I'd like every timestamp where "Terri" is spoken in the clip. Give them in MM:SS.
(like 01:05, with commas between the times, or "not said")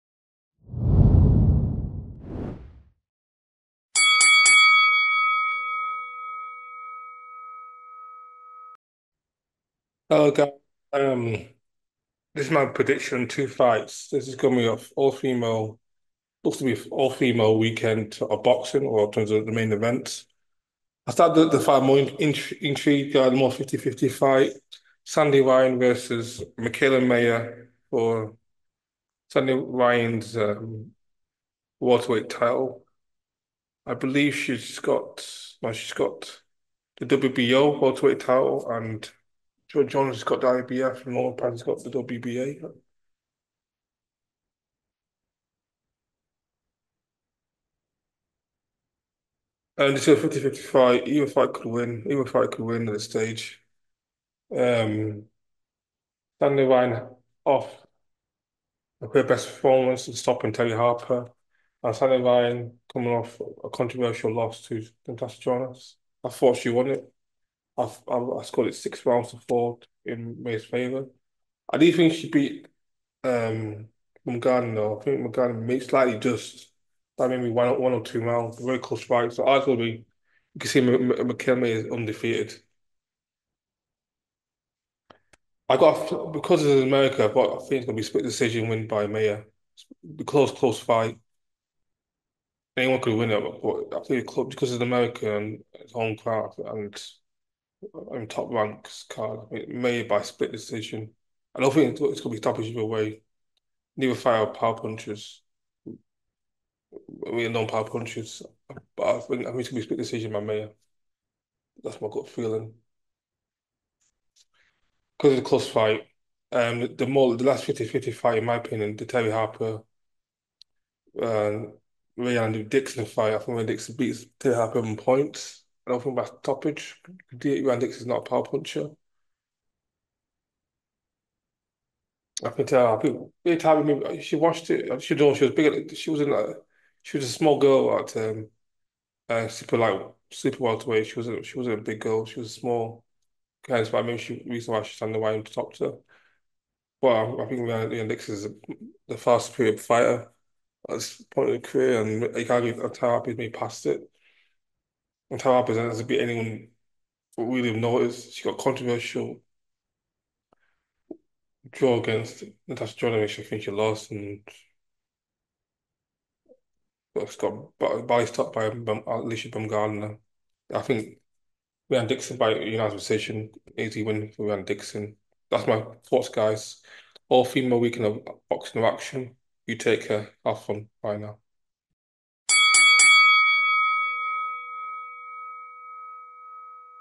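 01:00, 01:59, 02:04.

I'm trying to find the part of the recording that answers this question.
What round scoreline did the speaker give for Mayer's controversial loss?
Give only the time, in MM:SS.
01:08.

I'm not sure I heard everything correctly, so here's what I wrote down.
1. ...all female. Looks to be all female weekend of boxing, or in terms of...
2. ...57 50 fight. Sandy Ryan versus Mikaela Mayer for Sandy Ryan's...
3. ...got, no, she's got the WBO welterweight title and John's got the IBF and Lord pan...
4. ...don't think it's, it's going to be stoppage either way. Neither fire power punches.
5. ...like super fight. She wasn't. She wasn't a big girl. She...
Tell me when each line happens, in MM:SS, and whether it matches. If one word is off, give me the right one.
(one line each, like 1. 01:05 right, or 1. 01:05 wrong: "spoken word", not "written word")
1. 00:14 right
2. 00:23 wrong: "50", not "57"
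3. 00:34 right
4. 01:41 right
5. 02:19 wrong: "welterweight", not "fight".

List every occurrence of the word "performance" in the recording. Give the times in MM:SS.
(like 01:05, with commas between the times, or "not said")
00:59.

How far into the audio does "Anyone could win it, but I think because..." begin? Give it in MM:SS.
01:32.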